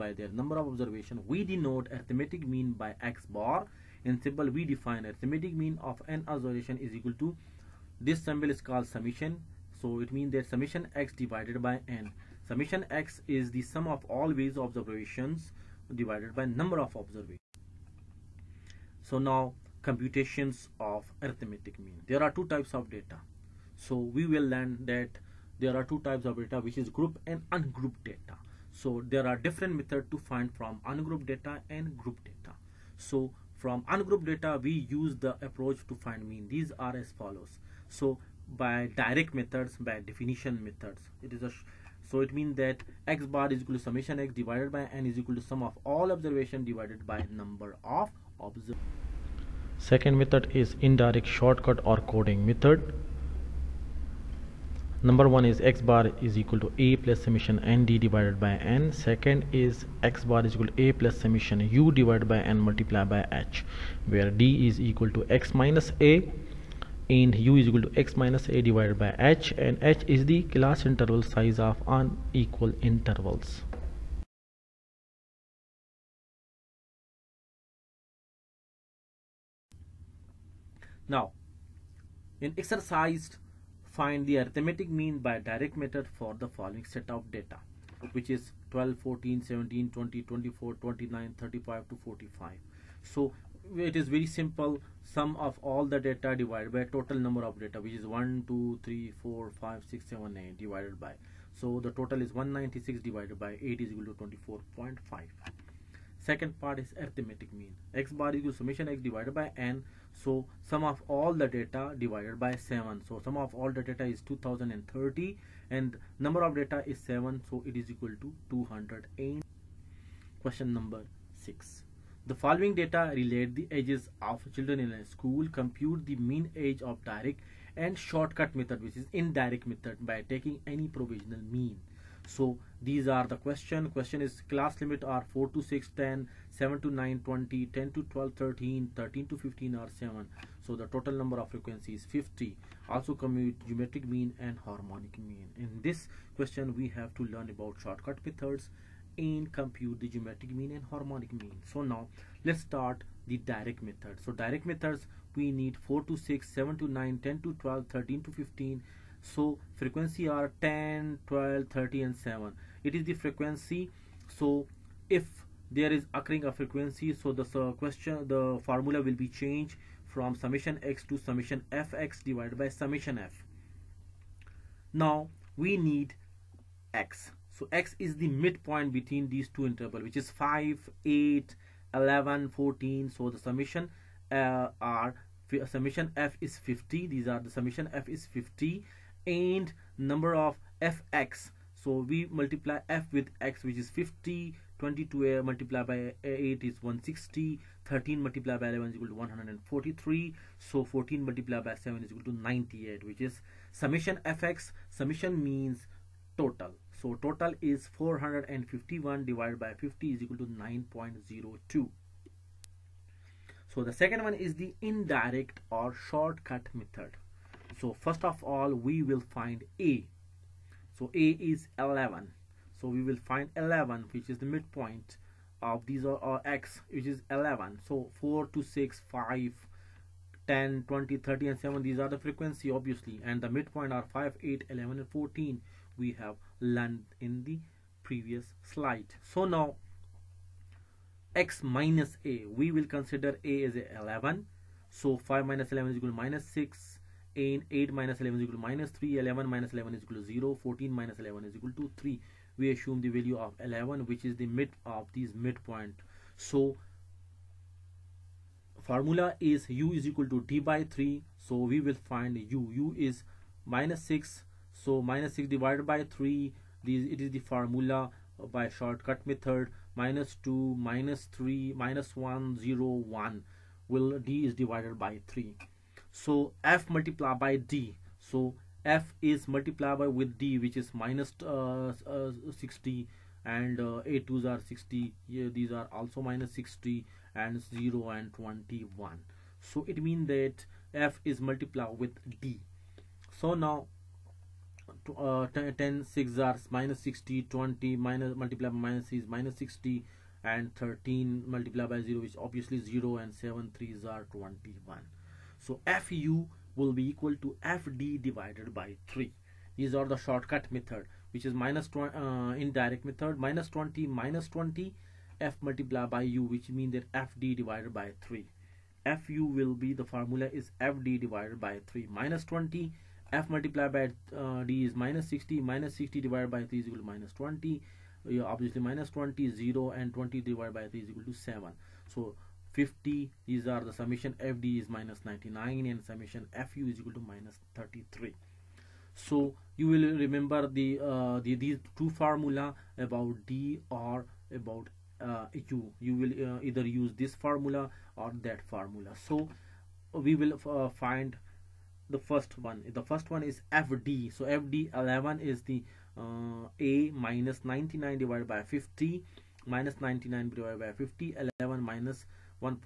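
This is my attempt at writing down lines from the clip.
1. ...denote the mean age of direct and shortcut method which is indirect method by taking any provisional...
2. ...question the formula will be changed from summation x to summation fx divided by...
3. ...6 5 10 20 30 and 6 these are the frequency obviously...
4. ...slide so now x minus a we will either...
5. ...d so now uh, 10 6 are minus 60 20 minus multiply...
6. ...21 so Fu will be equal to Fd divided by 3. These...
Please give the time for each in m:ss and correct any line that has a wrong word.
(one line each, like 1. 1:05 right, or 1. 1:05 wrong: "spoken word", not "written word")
1. 2:05 wrong: "compute", not "denote"
2. 2:47 right
3. 3:48 wrong: "7", not "6"
4. 3:58 wrong: "consider", not "either"
5. 4:52 right
6. 5:04 right.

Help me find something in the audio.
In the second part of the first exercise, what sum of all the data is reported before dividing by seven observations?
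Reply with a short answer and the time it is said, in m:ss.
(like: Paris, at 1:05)
2030, at 1:54.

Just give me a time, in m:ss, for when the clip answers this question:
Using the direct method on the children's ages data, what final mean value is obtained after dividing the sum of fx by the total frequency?
3:30.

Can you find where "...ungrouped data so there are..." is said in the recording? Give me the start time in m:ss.
0:27.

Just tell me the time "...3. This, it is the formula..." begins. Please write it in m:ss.
4:26.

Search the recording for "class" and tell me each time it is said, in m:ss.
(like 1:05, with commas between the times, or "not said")
1:10, 2:14.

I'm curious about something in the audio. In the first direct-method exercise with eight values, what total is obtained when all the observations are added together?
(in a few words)
196.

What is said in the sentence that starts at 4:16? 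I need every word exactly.
So formula is u is equal to d by 3.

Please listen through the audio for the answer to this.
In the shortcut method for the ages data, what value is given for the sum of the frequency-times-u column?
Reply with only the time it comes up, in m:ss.
5:37.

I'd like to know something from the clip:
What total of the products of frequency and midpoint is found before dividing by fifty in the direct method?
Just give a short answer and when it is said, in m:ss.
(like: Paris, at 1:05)
451, at 3:27.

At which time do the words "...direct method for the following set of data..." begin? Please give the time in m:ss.
1:25.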